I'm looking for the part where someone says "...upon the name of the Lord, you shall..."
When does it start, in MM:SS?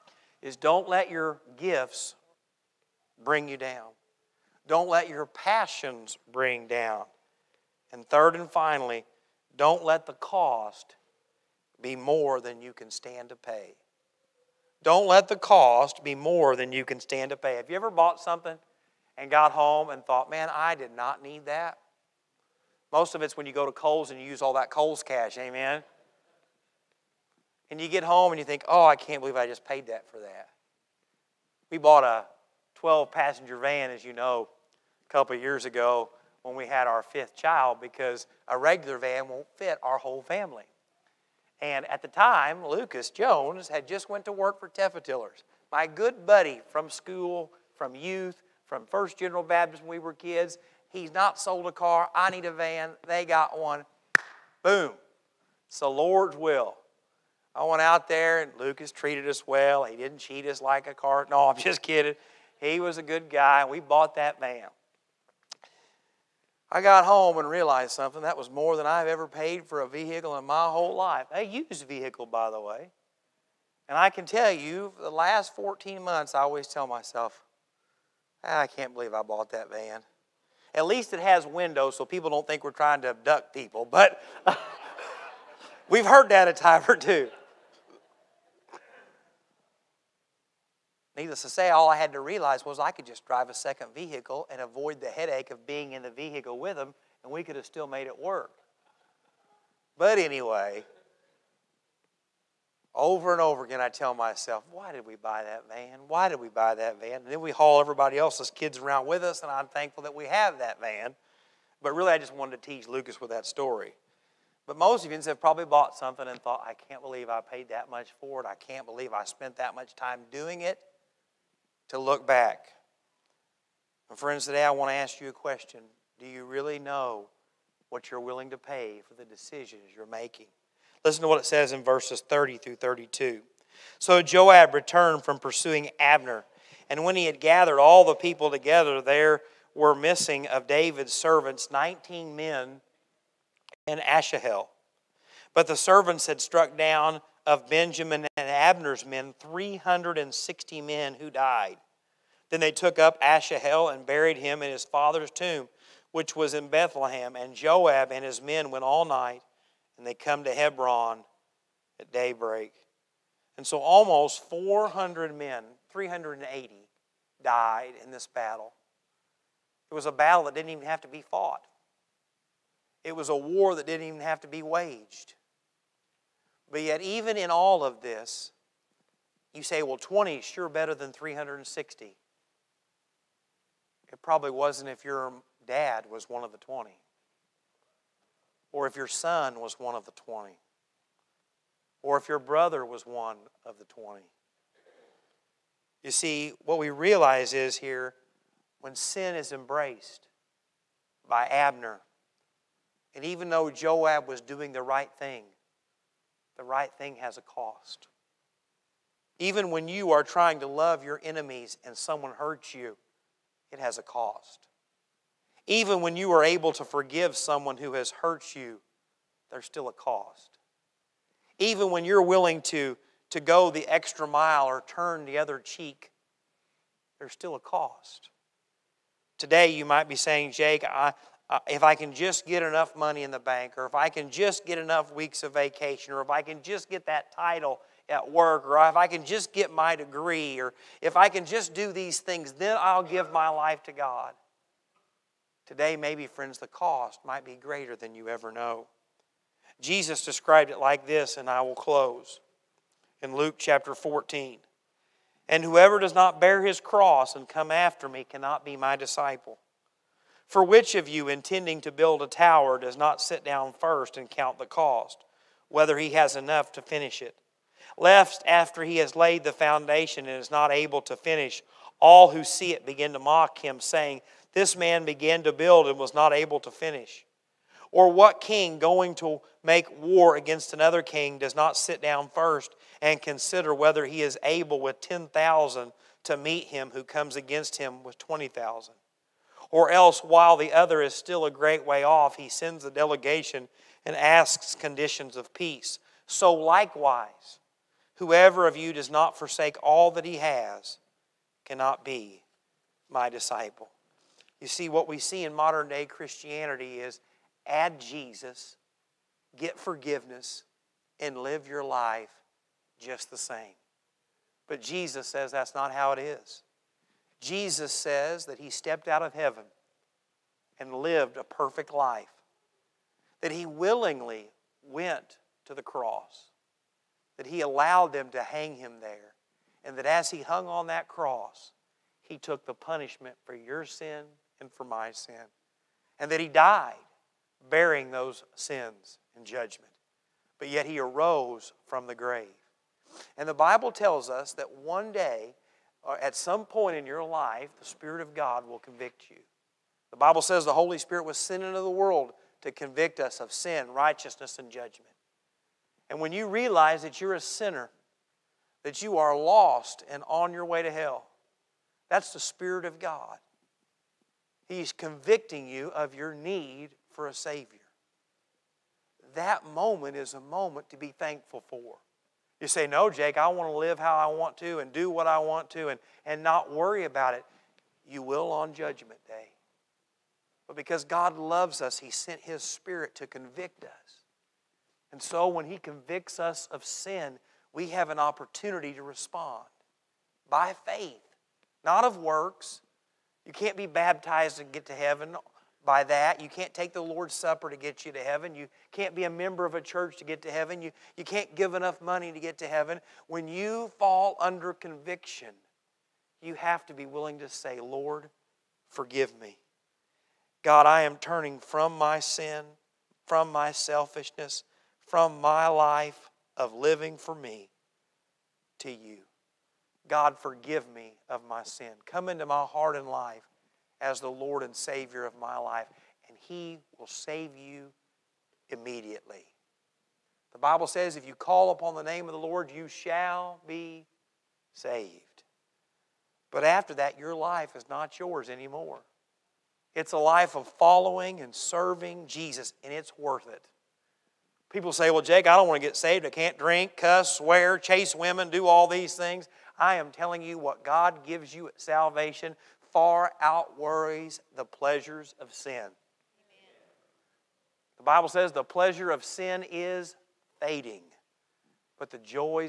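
07:11.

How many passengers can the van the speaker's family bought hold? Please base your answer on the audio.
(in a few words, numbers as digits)
12.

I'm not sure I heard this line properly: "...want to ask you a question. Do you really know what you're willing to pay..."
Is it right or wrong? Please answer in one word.
right.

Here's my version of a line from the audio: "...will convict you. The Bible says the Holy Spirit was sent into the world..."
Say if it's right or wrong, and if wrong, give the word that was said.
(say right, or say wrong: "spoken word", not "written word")
right.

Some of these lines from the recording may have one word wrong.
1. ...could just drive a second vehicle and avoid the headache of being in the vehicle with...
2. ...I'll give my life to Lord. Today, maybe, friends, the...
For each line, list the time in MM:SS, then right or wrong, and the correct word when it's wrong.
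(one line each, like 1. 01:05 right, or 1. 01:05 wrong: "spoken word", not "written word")
1. 01:32 right
2. 04:02 wrong: "God", not "Lord".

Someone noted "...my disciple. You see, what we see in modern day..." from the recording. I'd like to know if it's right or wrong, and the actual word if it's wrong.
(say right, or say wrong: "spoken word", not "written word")
right.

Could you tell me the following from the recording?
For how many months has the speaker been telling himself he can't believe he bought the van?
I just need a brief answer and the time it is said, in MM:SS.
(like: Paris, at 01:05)
14, at 01:15.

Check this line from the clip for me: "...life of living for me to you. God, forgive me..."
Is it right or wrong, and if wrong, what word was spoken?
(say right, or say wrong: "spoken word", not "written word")
right.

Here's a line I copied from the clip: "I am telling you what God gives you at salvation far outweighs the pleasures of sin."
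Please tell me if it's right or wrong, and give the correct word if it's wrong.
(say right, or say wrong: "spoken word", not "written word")
right.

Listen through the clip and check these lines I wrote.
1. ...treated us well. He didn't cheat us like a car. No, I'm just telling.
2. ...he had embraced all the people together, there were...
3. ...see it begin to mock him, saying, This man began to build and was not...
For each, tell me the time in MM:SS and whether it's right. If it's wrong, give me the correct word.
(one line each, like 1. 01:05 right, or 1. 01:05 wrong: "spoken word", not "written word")
1. 00:58 wrong: "kidding", not "telling"
2. 02:17 wrong: "gathered", not "embraced"
3. 04:32 right.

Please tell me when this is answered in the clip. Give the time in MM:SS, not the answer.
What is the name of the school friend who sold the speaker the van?
00:42.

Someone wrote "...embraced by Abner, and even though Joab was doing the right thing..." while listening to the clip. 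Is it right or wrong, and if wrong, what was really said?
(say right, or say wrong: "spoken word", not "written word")
right.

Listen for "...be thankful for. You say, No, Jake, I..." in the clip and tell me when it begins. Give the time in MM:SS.
06:10.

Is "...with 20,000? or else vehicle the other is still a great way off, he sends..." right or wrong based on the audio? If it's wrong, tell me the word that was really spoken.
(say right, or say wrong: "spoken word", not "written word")
wrong: "while", not "vehicle".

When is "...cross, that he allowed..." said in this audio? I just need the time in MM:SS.
05:25.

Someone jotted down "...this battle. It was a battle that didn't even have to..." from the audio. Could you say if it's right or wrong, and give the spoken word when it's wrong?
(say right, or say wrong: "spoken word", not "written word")
right.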